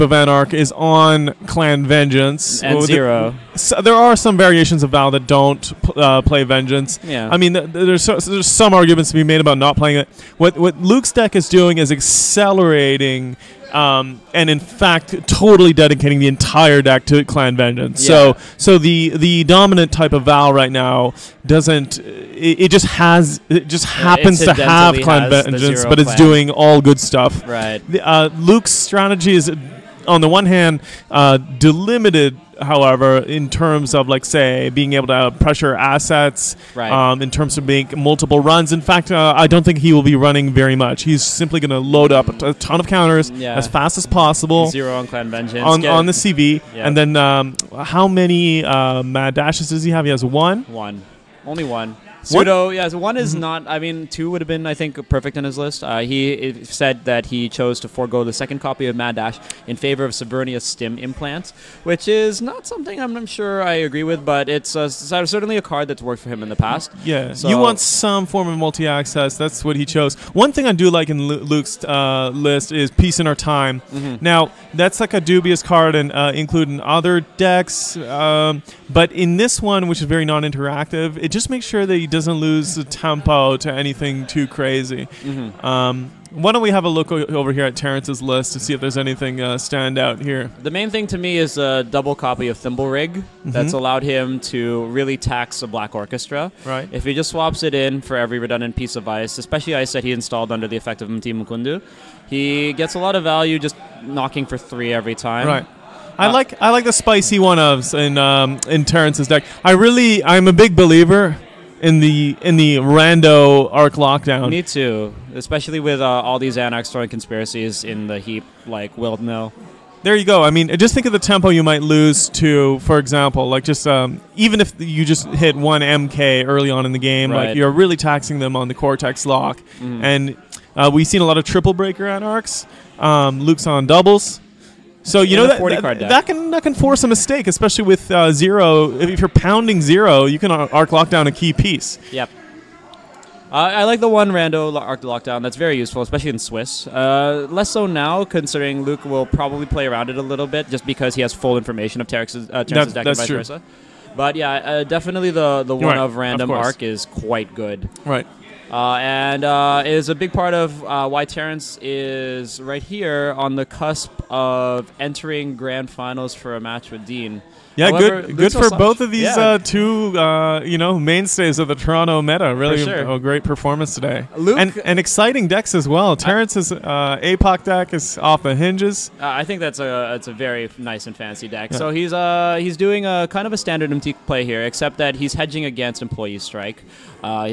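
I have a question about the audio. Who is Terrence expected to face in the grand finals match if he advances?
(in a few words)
Dien.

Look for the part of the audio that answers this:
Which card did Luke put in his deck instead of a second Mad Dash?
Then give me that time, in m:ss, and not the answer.
1:00.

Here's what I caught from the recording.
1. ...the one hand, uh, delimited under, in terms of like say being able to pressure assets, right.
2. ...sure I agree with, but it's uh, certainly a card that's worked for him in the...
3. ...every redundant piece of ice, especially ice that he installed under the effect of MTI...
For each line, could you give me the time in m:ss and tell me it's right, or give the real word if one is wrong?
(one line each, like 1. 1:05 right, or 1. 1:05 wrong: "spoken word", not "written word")
1. 0:30 wrong: "however", not "under"
2. 1:03 right
3. 1:38 right.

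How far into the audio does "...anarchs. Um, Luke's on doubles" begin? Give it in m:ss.
2:12.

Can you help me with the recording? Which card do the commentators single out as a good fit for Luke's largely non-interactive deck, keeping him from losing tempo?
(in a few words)
Peace in Our Time.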